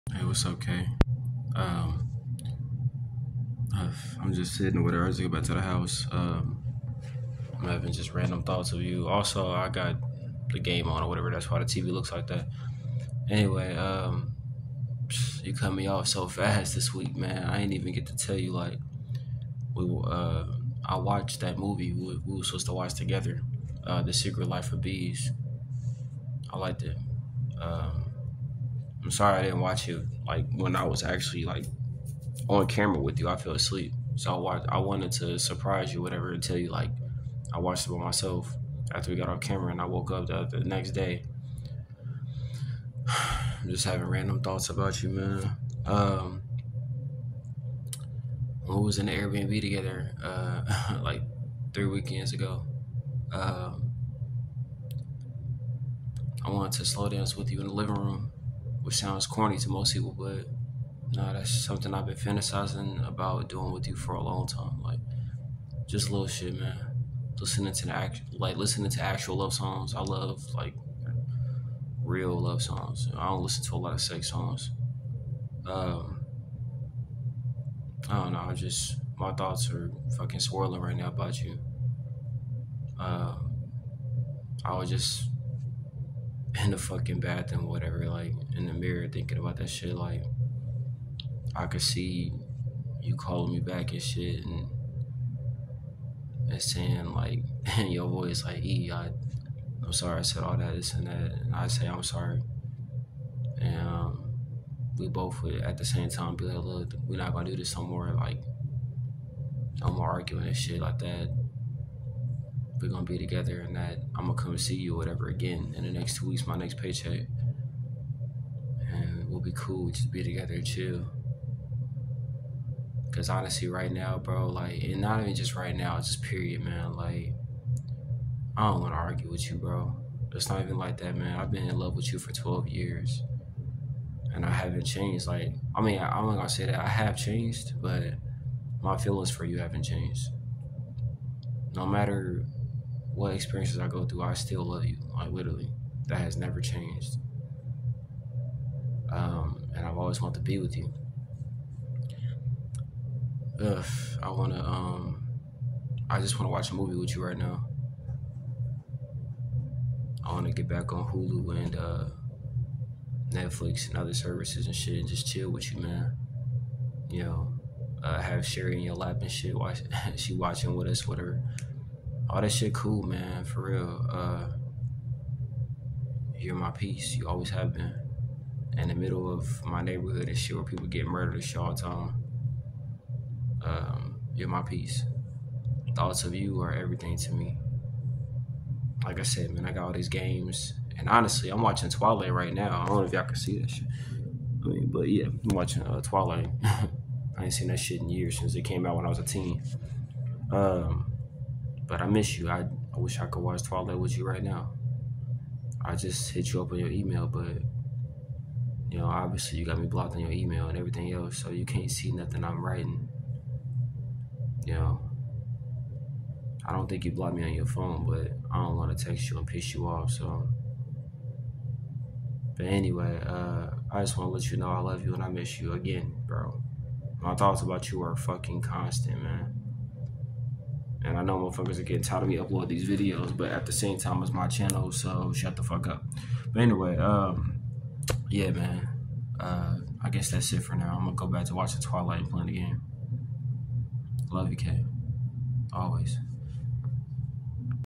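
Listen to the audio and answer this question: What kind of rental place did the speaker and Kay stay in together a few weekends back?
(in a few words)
Airbnb.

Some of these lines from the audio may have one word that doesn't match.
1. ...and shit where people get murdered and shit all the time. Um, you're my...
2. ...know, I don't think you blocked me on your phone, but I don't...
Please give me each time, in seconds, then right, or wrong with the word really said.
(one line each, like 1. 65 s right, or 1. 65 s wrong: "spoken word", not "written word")
1. 180 s right
2. 214 s right.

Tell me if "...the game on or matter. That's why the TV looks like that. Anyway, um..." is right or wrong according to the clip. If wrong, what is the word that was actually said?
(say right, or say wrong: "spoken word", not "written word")
wrong: "whatever", not "matter".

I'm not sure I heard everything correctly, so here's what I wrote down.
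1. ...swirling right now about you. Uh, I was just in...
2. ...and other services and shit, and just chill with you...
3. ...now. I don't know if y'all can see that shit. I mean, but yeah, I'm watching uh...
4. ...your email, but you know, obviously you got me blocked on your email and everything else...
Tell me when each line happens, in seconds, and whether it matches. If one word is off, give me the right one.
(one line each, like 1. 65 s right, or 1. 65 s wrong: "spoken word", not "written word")
1. 80 s right
2. 163 s right
3. 192 s right
4. 206 s right.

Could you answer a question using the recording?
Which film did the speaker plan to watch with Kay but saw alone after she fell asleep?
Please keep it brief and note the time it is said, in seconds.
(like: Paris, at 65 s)
The Secret Life of Bees, at 24 s.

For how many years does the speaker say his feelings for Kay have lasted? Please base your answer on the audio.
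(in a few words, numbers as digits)
12.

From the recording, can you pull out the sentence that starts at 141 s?
No matter what experiences I go through, I still love you.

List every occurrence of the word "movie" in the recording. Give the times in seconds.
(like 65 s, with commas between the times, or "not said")
21 s, 156 s.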